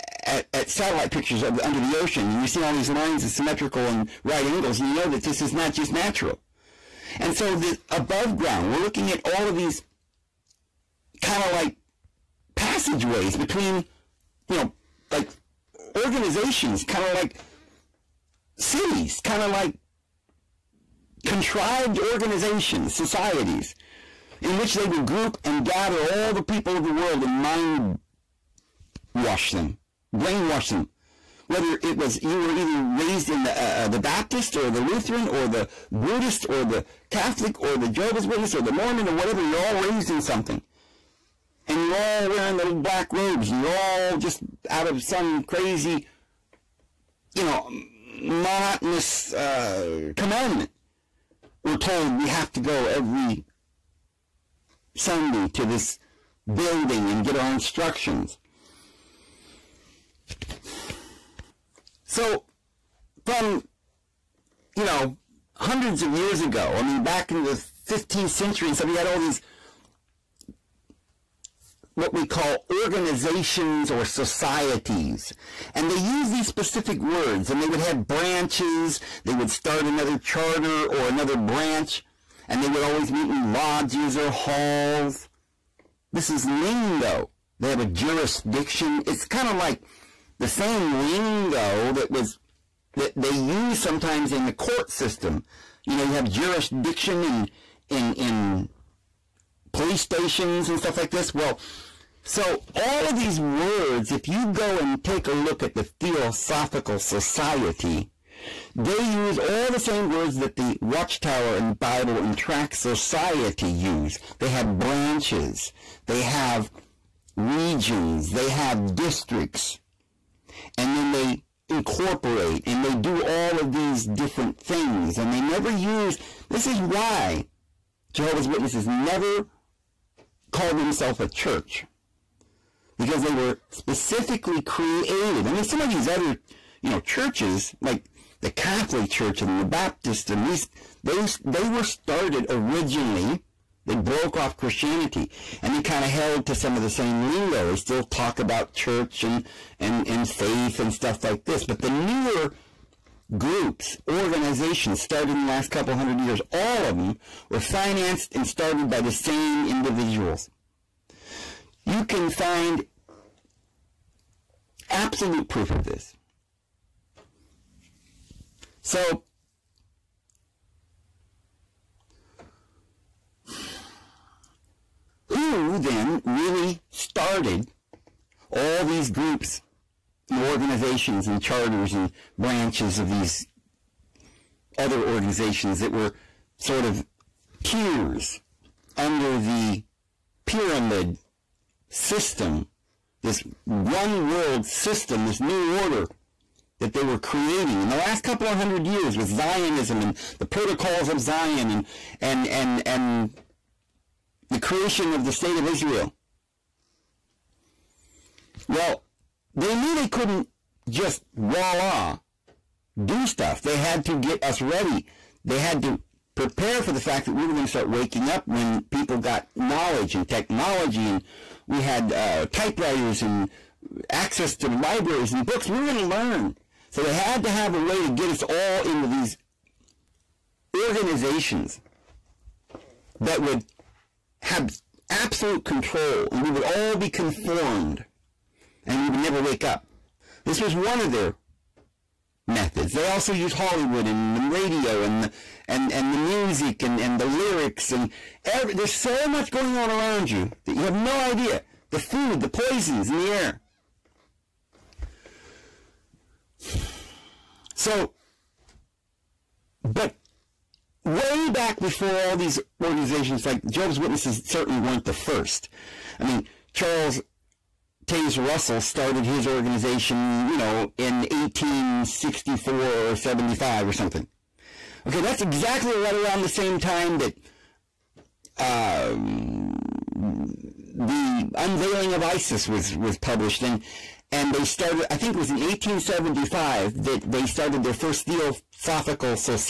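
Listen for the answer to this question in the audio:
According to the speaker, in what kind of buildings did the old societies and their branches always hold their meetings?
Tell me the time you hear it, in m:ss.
1:23.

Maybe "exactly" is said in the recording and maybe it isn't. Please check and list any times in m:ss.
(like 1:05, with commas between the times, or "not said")
4:35.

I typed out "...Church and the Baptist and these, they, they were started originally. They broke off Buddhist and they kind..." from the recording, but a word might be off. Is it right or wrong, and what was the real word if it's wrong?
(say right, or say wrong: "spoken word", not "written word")
wrong: "Christianity", not "Buddhist".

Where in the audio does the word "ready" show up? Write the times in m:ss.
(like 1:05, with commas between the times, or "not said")
3:34.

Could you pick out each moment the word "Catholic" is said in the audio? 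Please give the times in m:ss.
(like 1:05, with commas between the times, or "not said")
0:37, 2:18.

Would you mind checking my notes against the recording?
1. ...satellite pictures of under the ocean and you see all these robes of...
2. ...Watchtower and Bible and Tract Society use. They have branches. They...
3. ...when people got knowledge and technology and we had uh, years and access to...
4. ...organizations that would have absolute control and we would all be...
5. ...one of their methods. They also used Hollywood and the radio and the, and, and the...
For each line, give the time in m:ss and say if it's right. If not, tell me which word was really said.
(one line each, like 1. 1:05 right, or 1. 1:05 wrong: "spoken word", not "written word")
1. 0:00 wrong: "lines", not "robes"
2. 1:50 right
3. 3:38 wrong: "typewriters", not "years"
4. 3:50 right
5. 4:00 right.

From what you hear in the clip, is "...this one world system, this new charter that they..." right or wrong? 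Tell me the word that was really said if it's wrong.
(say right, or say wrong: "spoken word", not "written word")
wrong: "order", not "charter".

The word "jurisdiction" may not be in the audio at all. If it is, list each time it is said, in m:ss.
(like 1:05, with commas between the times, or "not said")
1:27, 1:36.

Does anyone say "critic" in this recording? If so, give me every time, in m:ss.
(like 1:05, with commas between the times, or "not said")
not said.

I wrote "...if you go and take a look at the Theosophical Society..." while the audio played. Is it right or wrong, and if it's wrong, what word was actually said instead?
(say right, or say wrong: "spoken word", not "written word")
right.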